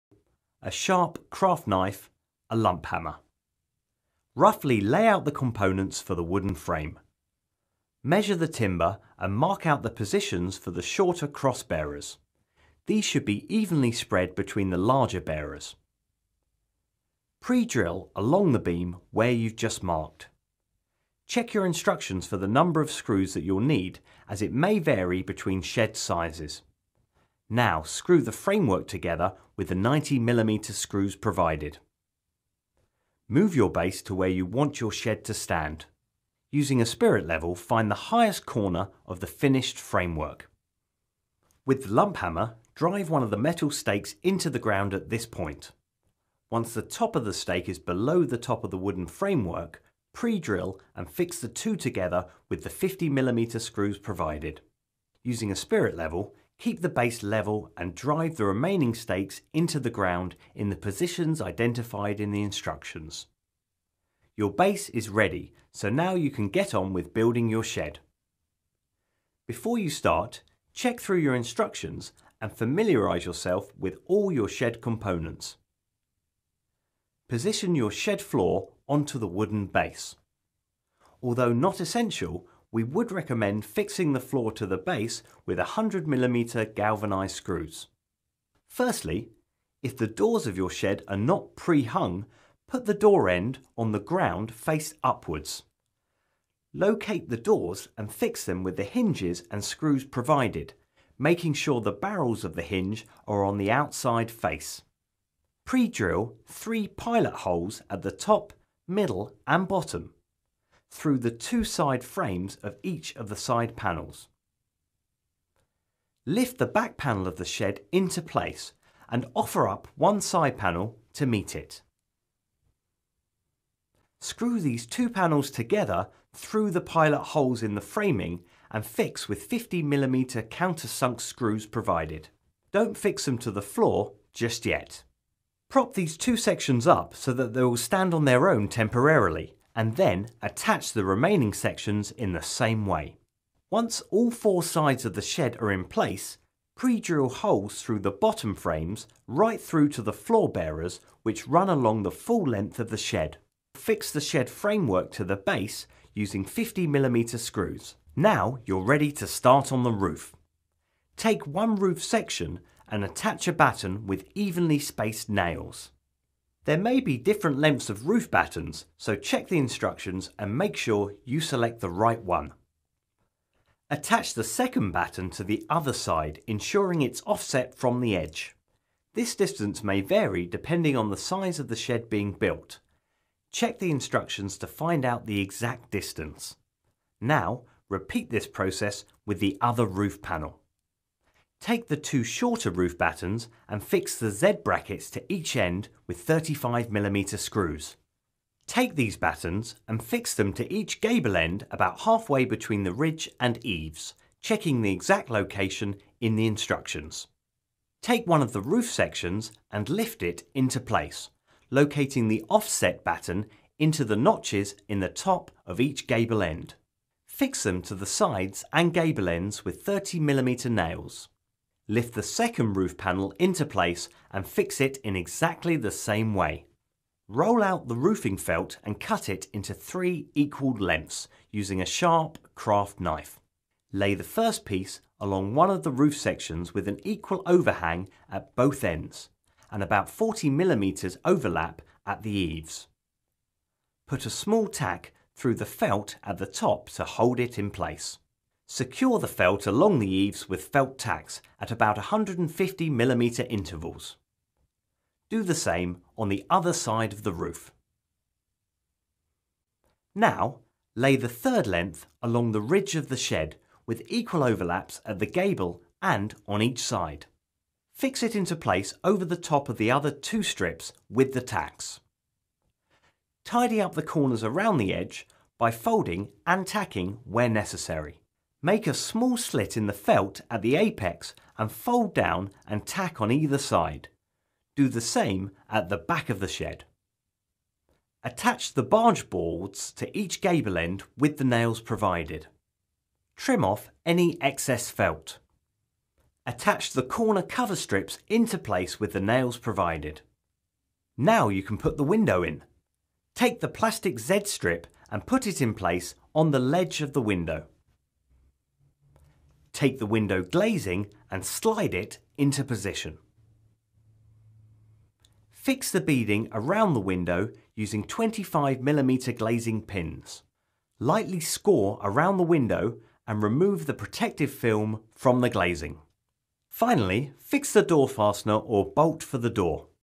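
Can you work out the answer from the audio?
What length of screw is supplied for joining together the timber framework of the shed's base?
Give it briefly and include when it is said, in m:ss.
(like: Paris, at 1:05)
90mm, at 0:29.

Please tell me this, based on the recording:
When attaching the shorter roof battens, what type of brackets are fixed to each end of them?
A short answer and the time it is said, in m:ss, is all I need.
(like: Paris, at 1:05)
Z brackets, at 3:14.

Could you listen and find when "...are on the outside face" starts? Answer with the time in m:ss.
1:43.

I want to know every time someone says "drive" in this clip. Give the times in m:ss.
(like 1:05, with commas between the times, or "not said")
0:42, 0:57.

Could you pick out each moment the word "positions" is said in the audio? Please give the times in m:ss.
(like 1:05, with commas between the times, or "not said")
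0:09, 1:00, 1:17, 5:12.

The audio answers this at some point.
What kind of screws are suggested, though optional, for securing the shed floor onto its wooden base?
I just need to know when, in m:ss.
1:25.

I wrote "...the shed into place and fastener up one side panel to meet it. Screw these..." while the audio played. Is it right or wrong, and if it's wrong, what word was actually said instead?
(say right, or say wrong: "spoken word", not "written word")
wrong: "offer", not "fastener".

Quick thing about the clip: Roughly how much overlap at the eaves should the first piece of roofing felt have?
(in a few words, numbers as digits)
40 millimeters.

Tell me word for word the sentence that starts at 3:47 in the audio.
Roll out the roofing felt and cut it into three equal lengths using a sharp craft knife.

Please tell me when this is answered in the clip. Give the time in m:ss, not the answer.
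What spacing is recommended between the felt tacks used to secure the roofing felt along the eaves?
4:11.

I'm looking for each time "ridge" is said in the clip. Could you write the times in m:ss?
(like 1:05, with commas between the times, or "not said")
3:22, 4:22.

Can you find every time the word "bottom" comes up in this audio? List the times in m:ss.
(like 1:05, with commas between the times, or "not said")
1:49, 2:28.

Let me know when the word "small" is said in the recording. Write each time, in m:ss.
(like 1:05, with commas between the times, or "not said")
4:04, 4:38.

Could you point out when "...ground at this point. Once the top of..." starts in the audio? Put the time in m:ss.
0:44.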